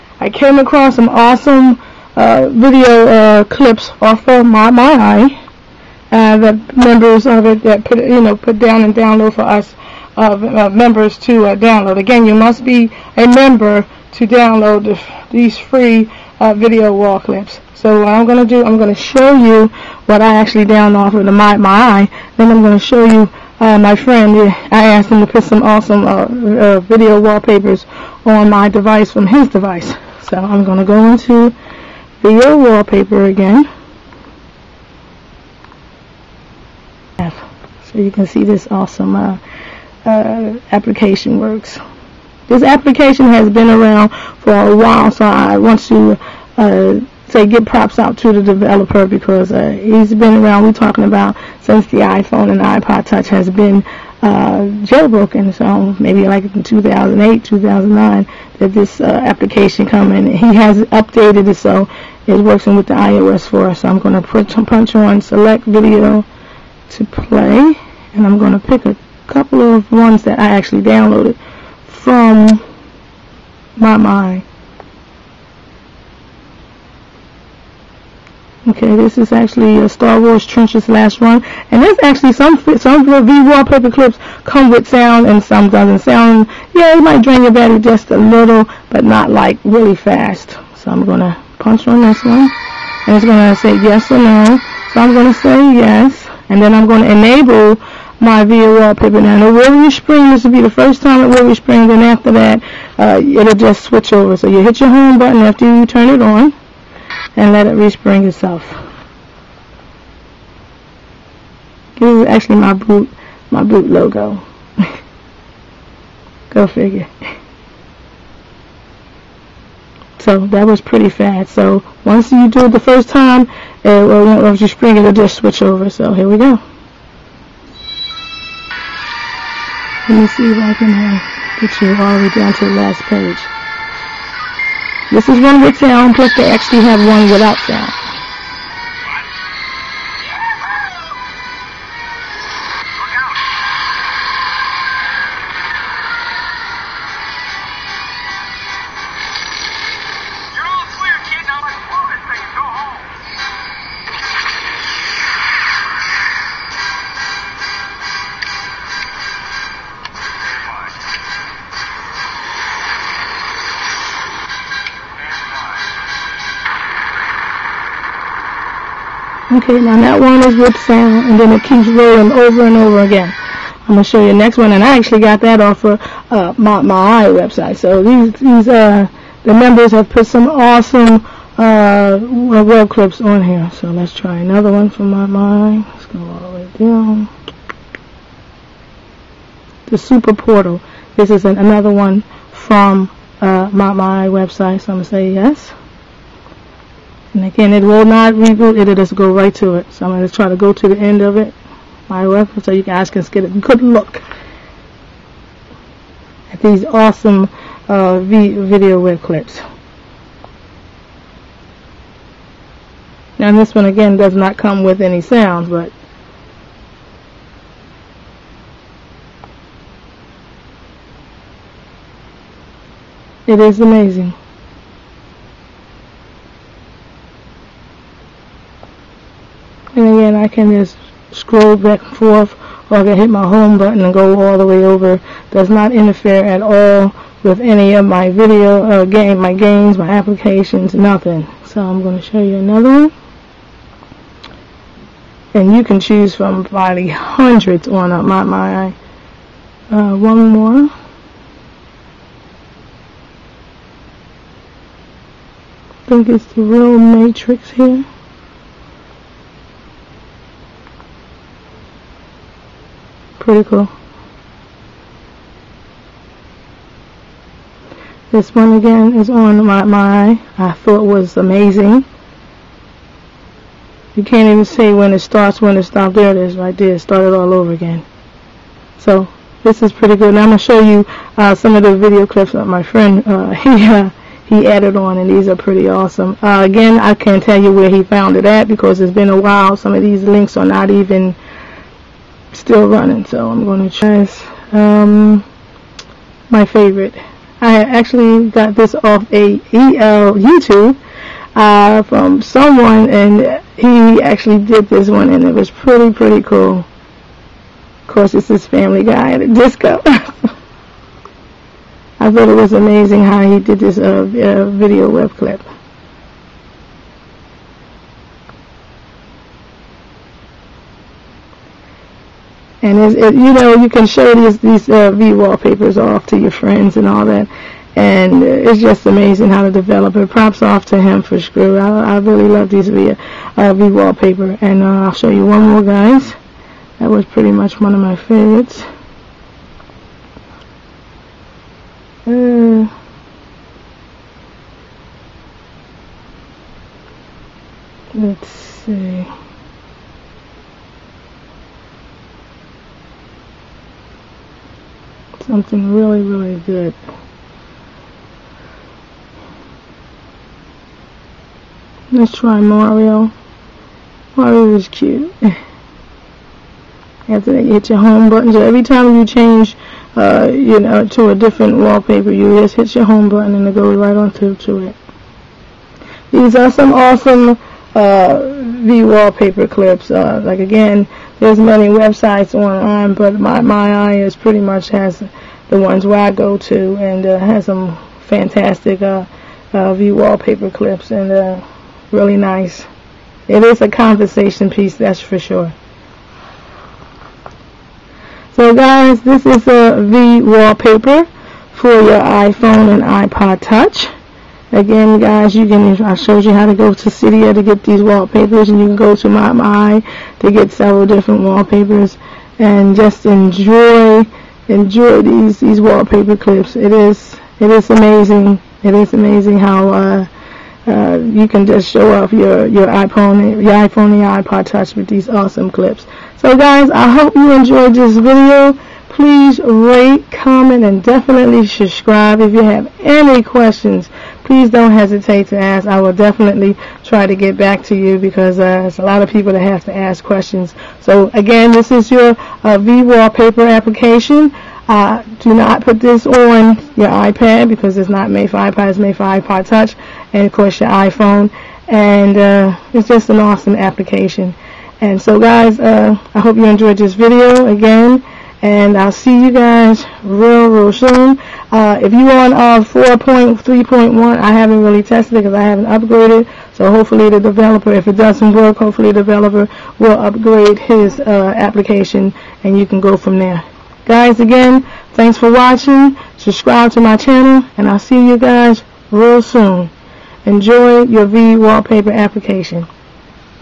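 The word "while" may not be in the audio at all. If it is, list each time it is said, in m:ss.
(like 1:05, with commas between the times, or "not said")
0:44, 4:49.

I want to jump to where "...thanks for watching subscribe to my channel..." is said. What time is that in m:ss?
7:55.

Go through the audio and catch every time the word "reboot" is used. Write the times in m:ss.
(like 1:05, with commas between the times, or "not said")
3:18.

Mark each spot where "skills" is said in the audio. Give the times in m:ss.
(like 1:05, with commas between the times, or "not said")
not said.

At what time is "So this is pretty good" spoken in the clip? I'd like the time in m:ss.
4:38.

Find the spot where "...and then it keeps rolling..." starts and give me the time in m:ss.
2:51.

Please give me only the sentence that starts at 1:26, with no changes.
Sound, yeah, it might drain your battery just a little, but not like really fast.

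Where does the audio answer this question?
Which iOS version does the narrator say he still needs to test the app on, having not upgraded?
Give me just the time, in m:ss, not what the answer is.
7:42.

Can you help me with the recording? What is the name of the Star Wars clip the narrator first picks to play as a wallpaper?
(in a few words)
Trenches last run.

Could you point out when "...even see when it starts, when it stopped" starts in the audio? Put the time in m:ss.
4:34.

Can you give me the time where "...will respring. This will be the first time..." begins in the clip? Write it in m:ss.
1:39.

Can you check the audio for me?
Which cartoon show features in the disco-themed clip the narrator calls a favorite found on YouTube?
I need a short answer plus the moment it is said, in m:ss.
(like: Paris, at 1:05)
Family Guy, at 5:08.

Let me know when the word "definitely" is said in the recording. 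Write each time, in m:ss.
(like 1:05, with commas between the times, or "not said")
7:11, 7:16.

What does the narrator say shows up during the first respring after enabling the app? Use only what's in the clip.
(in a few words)
boot logo.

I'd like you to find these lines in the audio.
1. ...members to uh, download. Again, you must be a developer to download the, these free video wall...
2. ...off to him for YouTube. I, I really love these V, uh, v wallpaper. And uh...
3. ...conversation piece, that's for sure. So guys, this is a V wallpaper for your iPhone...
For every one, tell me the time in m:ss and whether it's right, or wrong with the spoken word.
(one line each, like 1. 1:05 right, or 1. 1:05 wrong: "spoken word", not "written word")
1. 0:10 wrong: "member", not "developer"
2. 5:30 wrong: "Skrew", not "YouTube"
3. 6:33 right.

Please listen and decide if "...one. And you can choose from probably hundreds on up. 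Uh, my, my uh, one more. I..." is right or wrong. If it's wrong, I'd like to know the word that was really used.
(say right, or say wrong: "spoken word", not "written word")
right.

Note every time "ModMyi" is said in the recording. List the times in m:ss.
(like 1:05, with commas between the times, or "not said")
0:04, 0:21.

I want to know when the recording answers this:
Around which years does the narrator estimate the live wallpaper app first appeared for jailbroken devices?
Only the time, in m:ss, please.
0:56.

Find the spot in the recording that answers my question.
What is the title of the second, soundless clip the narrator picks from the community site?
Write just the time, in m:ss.
3:09.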